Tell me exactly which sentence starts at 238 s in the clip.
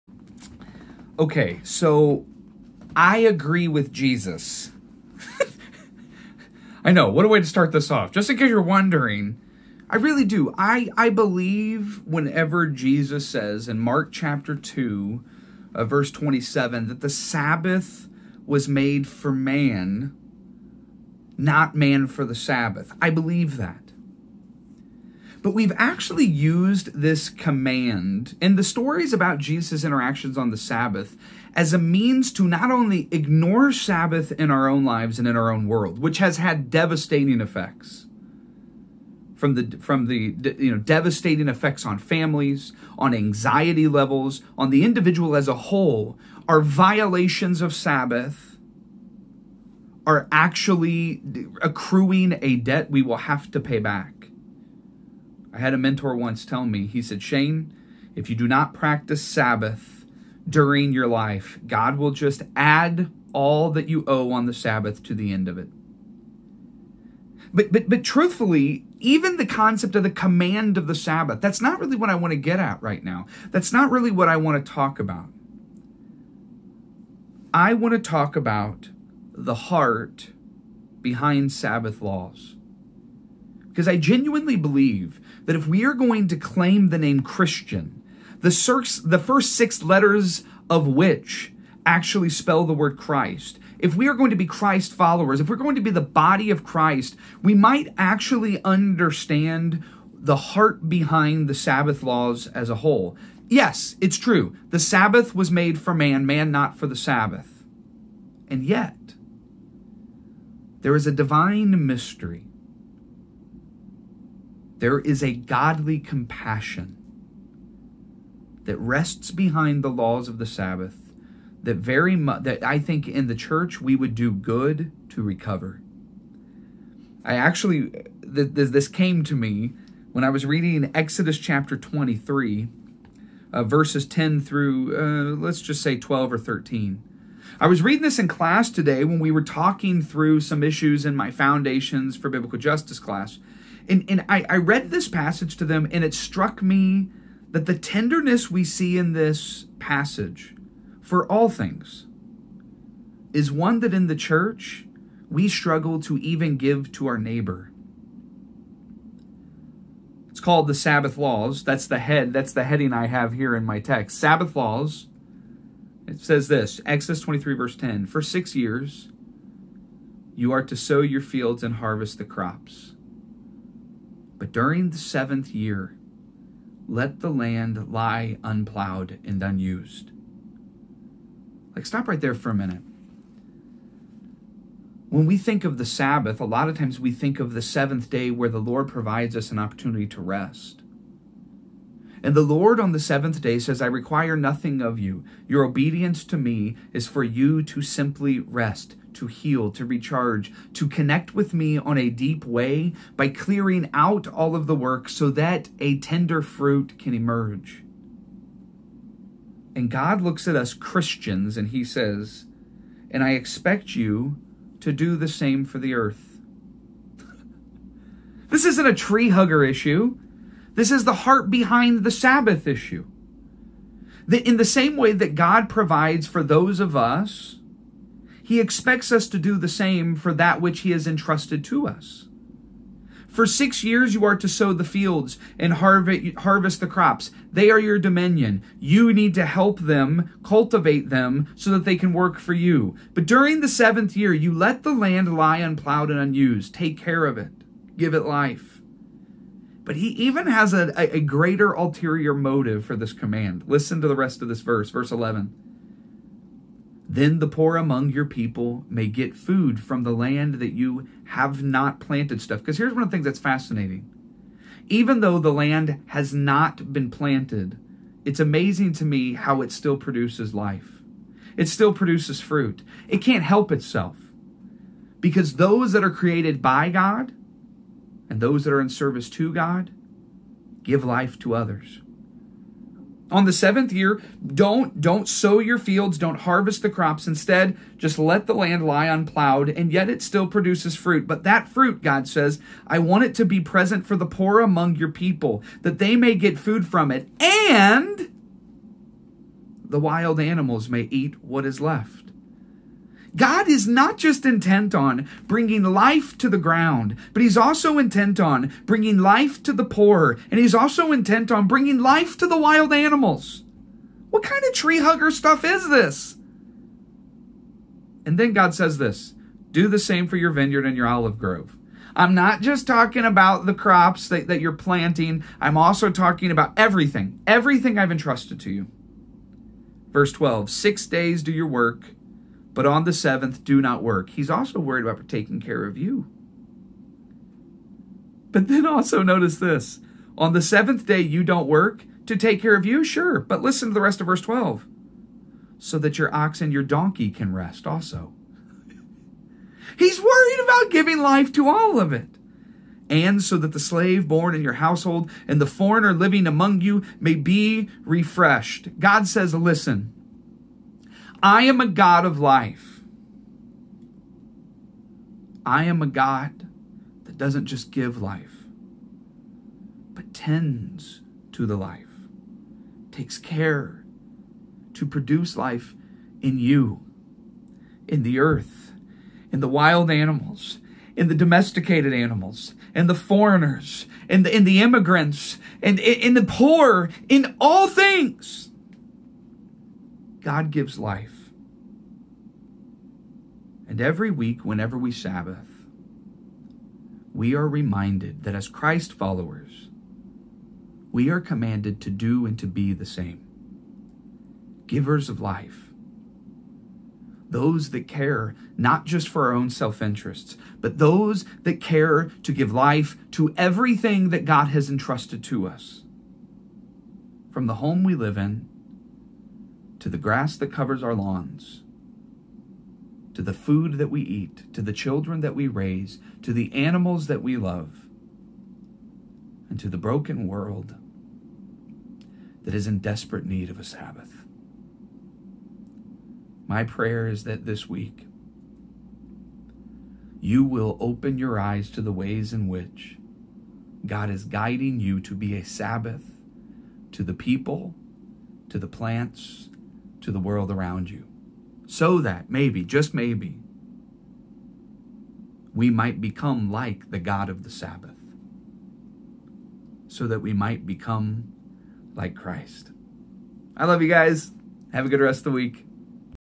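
You need to help them, cultivate them, so that they can work for you.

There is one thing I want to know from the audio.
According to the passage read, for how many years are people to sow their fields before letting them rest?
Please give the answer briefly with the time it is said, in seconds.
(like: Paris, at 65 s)
6, at 168 s.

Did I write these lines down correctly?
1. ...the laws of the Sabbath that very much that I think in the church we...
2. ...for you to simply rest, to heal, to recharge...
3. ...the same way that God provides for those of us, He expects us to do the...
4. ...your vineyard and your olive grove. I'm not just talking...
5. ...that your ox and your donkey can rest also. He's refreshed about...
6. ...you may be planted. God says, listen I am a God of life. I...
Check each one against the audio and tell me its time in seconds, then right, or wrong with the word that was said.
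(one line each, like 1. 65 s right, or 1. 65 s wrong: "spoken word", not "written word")
1. 119 s right
2. 197 s right
3. 224 s right
4. 320 s right
5. 345 s wrong: "worried", not "refreshed"
6. 356 s wrong: "refreshed", not "planted".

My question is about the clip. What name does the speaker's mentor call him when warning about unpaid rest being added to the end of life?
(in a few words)
Shane.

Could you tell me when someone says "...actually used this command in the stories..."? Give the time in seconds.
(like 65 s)
25 s.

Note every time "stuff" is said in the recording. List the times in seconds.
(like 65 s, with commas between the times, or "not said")
262 s, 315 s.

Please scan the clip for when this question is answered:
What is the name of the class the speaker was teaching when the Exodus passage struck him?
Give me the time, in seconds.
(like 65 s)
141 s.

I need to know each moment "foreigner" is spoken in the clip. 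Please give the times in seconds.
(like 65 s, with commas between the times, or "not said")
355 s, 383 s.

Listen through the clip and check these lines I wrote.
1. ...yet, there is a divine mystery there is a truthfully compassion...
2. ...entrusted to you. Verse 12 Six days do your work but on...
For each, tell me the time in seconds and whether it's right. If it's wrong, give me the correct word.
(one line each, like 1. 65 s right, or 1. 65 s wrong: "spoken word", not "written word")
1. 108 s wrong: "godly", not "truthfully"
2. 328 s right.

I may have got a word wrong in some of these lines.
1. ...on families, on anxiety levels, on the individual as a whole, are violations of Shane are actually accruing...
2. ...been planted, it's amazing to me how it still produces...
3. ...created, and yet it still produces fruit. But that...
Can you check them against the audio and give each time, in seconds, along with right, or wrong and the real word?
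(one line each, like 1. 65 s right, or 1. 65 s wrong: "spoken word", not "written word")
1. 41 s wrong: "Sabbath", not "Shane"
2. 266 s right
3. 289 s wrong: "unplowed", not "created".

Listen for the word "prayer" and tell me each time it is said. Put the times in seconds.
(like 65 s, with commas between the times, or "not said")
436 s.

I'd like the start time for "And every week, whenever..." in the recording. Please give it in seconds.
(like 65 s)
393 s.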